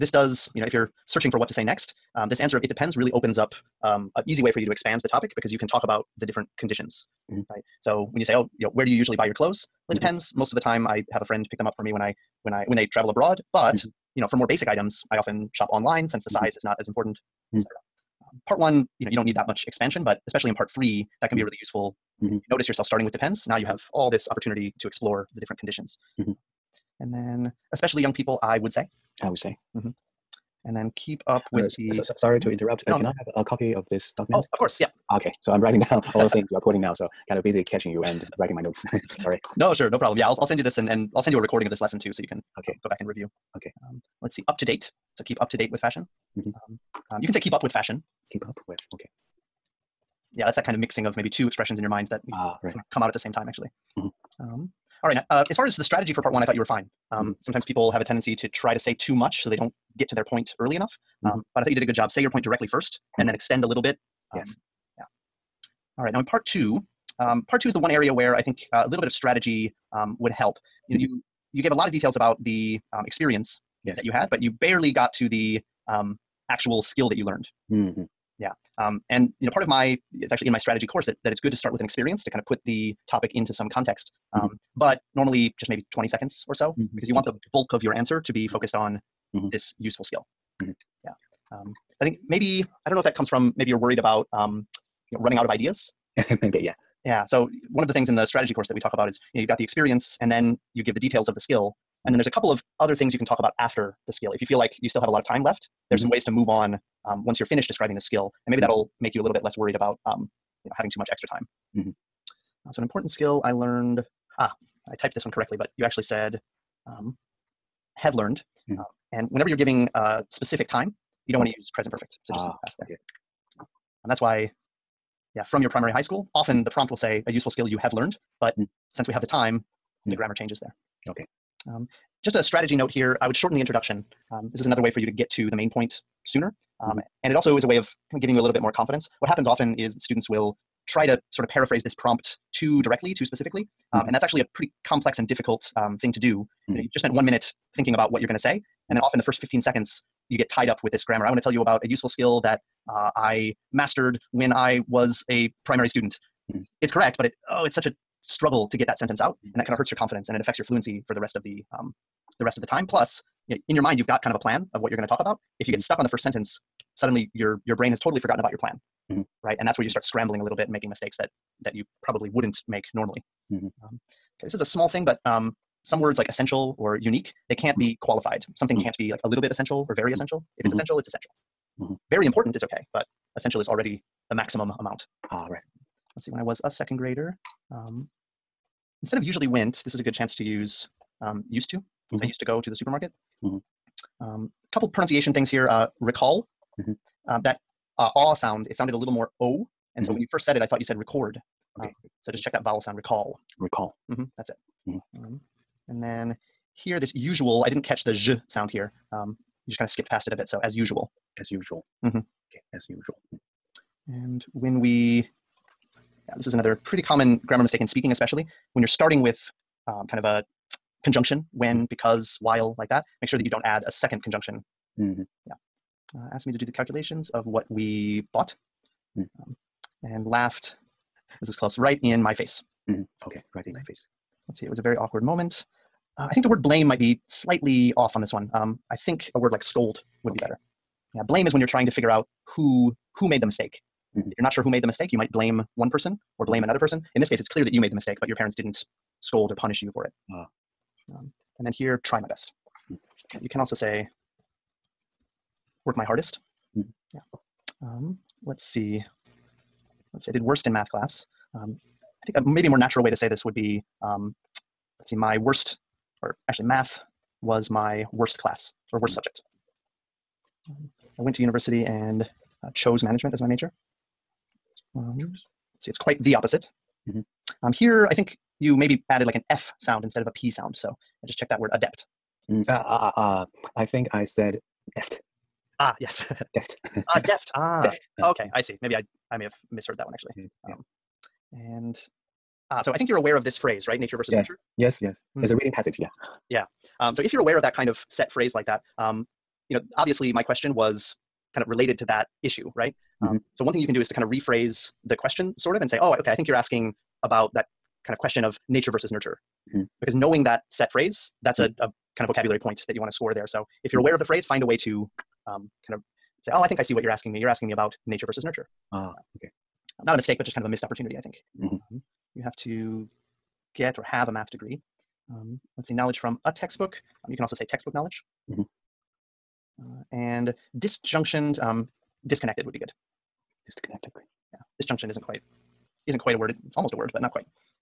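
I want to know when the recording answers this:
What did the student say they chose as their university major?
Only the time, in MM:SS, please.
04:33.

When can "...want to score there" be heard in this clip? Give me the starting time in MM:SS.
05:13.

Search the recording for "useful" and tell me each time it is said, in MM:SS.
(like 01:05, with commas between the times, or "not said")
00:21, 01:29, 02:07, 02:31.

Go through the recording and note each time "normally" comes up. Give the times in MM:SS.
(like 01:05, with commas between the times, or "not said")
01:25, 02:52.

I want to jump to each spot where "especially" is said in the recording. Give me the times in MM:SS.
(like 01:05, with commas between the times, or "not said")
00:20, 00:27, 03:38.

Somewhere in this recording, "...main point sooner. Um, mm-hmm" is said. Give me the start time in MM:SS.
02:15.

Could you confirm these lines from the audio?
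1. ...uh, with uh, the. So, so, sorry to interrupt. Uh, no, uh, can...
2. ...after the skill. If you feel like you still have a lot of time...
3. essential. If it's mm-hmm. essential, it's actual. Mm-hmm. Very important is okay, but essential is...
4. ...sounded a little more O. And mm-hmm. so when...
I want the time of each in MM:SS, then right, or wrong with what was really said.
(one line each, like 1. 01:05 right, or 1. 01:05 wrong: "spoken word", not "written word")
1. 00:31 right
2. 01:43 right
3. 03:00 wrong: "essential", not "actual"
4. 03:18 right.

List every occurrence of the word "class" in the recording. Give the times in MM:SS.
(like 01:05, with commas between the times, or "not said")
04:20, 04:28.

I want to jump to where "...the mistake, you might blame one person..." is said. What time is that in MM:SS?
04:04.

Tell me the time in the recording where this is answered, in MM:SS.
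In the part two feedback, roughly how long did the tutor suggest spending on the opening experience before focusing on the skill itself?
01:25.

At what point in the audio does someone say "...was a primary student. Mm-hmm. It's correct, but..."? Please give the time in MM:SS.
02:34.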